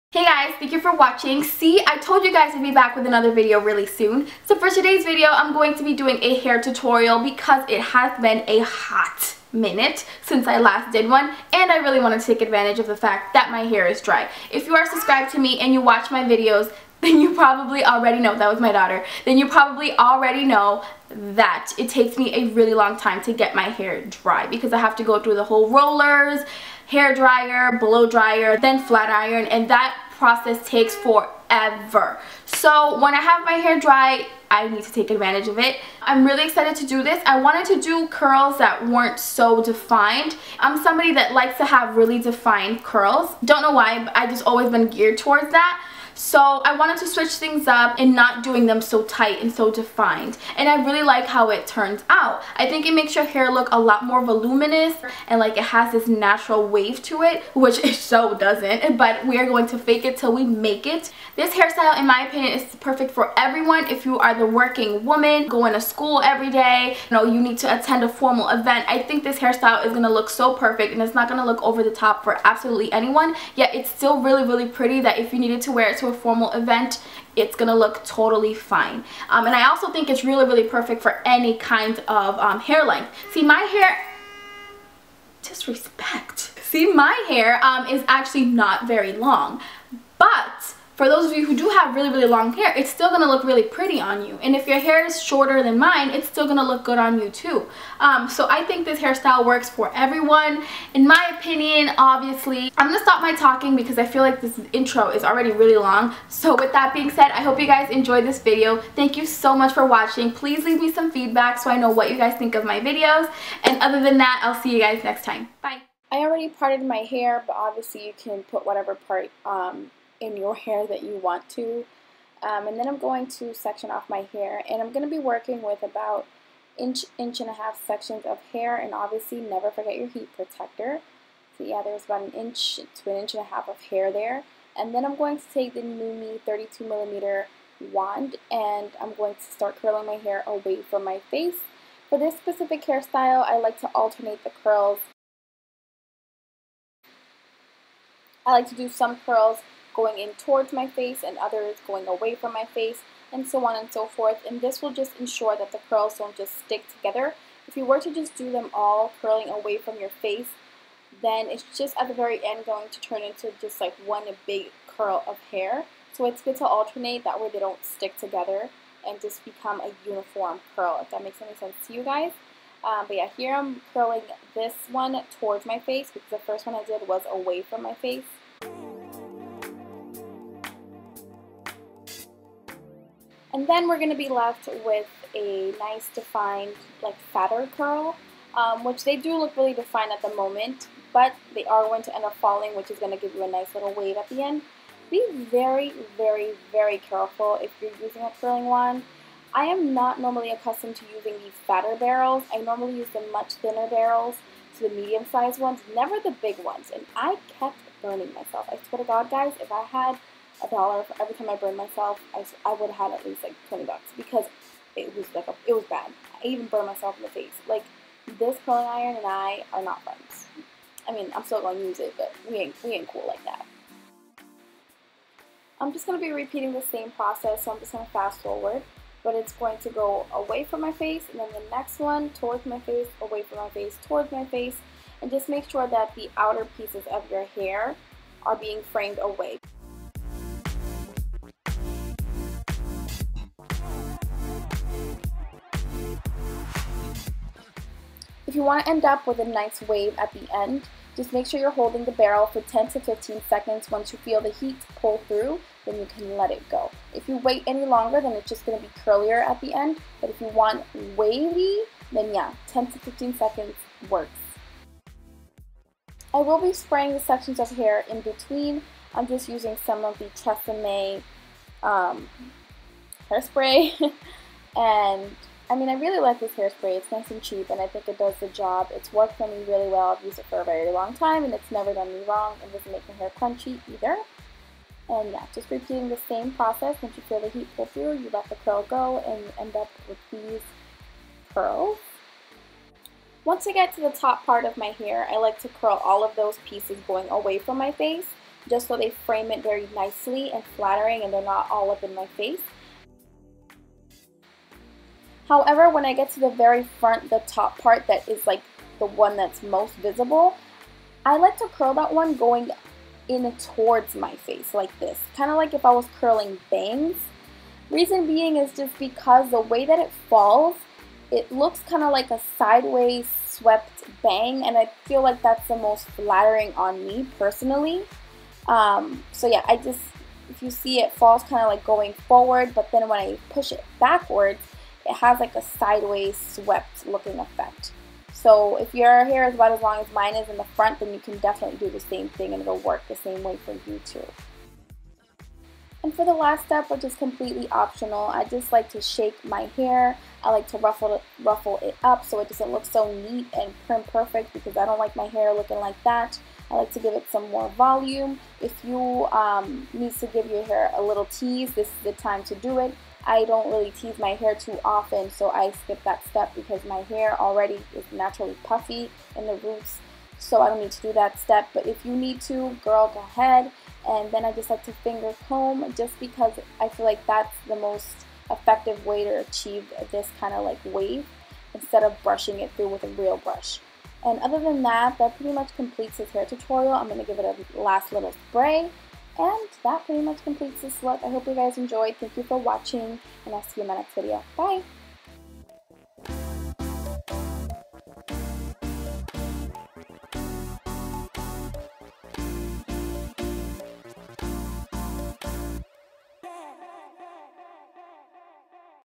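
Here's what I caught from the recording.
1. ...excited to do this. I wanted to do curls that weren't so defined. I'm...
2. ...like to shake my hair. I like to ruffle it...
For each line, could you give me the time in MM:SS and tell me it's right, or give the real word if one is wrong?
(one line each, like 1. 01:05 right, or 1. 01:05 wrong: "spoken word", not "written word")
1. 00:36 right
2. 05:48 right.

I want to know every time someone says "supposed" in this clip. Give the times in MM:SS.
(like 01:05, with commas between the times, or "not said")
not said.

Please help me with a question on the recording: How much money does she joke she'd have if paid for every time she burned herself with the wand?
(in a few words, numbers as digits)
20 bucks.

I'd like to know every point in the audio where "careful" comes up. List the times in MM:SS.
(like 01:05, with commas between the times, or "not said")
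03:16.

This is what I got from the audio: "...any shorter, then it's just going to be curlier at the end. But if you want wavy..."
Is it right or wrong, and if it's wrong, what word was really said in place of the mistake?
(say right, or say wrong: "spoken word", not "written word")
wrong: "longer", not "shorter".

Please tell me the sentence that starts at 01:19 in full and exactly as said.
Um, and I also think it's really, really perfect for any kind of um, hair length.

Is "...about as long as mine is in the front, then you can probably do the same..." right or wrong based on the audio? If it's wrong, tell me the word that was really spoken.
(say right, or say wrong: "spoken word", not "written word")
wrong: "definitely", not "probably".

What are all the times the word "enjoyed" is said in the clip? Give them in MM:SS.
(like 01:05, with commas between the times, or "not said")
01:47, 06:31.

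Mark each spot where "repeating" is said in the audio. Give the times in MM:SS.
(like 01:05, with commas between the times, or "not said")
03:46, 04:45.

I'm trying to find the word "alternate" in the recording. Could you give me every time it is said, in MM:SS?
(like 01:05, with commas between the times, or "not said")
02:23, 02:46.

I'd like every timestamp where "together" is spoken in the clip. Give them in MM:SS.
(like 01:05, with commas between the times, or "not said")
02:36, 02:48.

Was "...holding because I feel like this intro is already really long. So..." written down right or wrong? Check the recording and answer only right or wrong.
wrong.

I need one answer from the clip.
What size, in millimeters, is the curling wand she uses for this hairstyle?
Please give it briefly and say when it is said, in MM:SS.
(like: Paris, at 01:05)
32 millimeter, at 02:16.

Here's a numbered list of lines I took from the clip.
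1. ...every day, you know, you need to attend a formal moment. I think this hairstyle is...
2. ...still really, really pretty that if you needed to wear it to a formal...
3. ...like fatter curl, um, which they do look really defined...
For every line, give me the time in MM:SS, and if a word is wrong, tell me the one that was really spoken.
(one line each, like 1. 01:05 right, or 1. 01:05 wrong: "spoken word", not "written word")
1. 01:06 wrong: "event", not "moment"
2. 01:13 right
3. 03:07 right.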